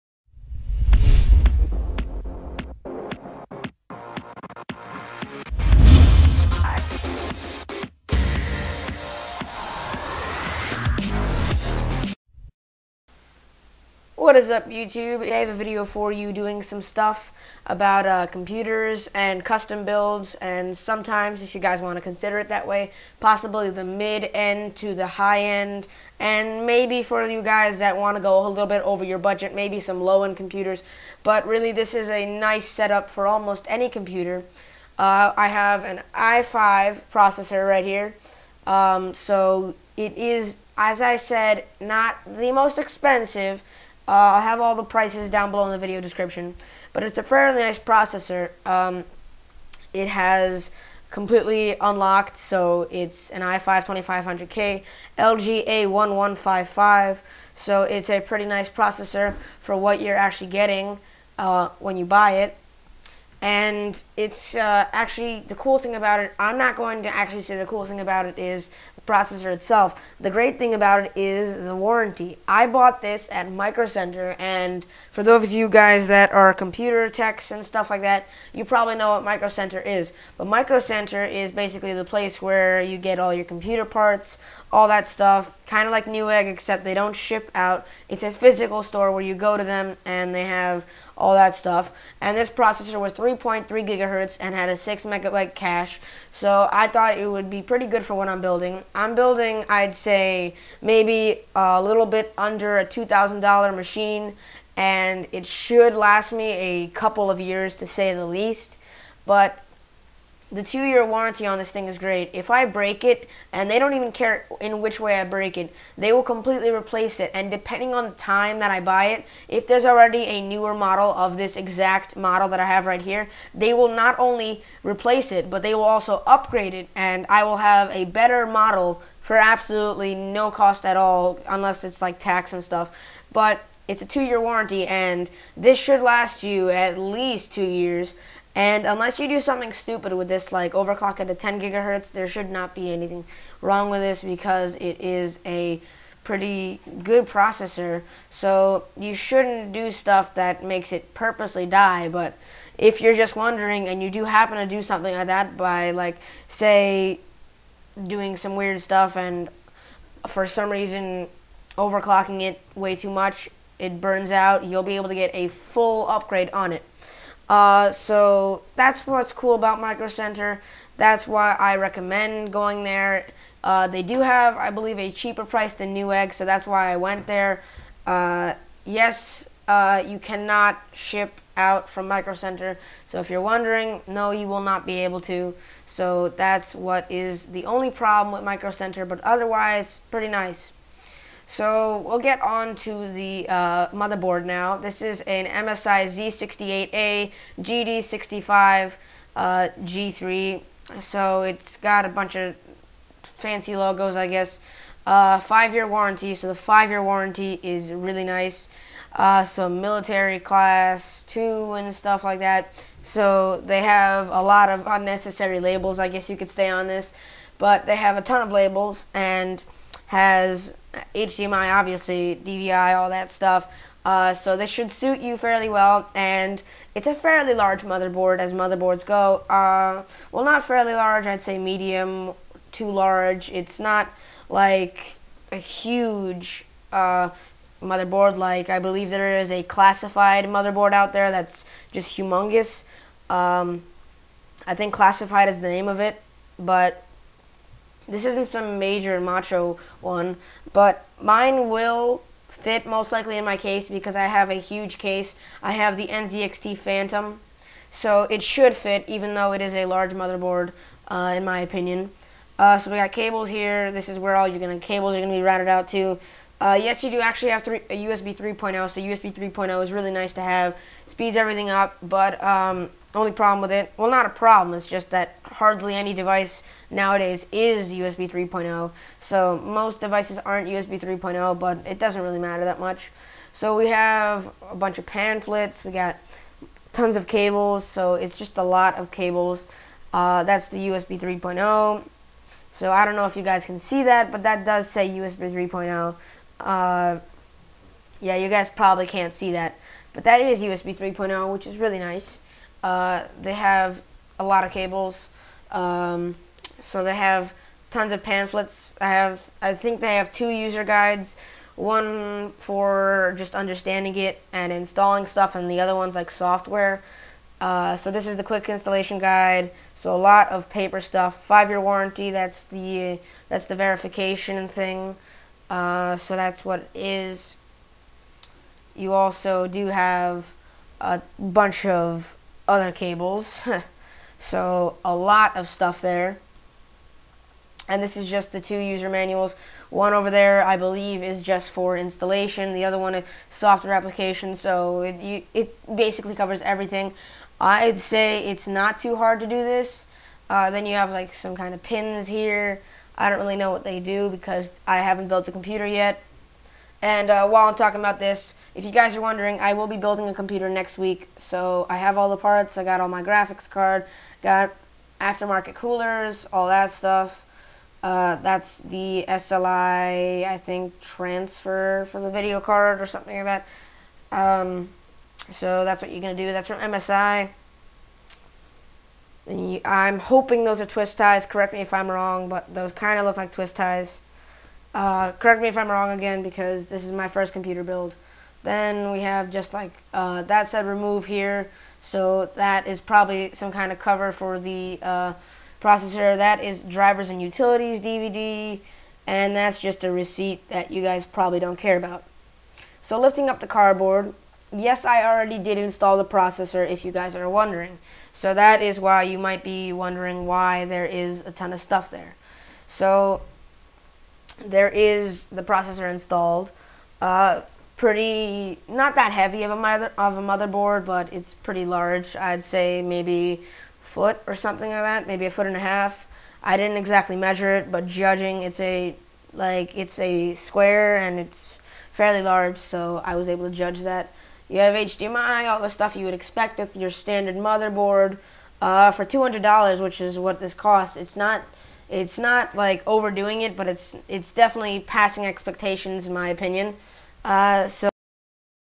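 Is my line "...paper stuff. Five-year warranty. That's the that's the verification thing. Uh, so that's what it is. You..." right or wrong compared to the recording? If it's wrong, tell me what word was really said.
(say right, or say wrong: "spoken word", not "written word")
right.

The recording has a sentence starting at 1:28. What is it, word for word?
It's a physical store where you go to them and they have all that stuff.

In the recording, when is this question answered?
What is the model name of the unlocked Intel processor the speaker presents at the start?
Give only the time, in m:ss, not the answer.
0:53.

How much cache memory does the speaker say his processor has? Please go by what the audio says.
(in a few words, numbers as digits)
6 megabyte.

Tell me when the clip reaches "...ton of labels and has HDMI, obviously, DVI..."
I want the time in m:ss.
3:38.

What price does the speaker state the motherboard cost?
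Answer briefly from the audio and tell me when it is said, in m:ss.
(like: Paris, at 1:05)
$200, at 7:19.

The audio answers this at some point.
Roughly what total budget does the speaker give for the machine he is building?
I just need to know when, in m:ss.
1:42.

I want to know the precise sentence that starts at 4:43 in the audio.
So we have a bunch of pamphlets, we got tons of cables, so it's just a lot of cables.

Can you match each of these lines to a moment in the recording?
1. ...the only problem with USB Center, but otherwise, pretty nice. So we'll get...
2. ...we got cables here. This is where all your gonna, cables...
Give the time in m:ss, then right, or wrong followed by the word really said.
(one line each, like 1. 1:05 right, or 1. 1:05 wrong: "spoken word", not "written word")
1. 3:07 wrong: "Micro", not "USB"
2. 4:22 right.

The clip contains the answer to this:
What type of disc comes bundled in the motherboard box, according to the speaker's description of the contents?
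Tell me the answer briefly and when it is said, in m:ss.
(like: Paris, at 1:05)
drivers and utilities DVD, at 6:36.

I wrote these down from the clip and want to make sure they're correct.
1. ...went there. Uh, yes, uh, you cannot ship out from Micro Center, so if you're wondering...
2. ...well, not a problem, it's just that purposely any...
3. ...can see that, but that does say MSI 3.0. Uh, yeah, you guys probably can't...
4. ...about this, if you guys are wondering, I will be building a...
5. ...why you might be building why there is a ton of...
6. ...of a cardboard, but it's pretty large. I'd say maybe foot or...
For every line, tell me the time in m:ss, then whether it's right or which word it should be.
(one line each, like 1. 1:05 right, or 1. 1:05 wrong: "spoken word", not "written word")
1. 2:56 right
2. 4:33 wrong: "hardly", not "purposely"
3. 4:53 wrong: "USB", not "MSI"
4. 5:57 right
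5. 6:49 wrong: "wondering", not "building"
6. 7:00 wrong: "motherboard", not "cardboard".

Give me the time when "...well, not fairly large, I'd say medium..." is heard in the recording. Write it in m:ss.
3:50.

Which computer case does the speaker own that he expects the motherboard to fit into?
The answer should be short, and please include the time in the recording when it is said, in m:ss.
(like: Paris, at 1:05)
NZXT Phantom, at 4:16.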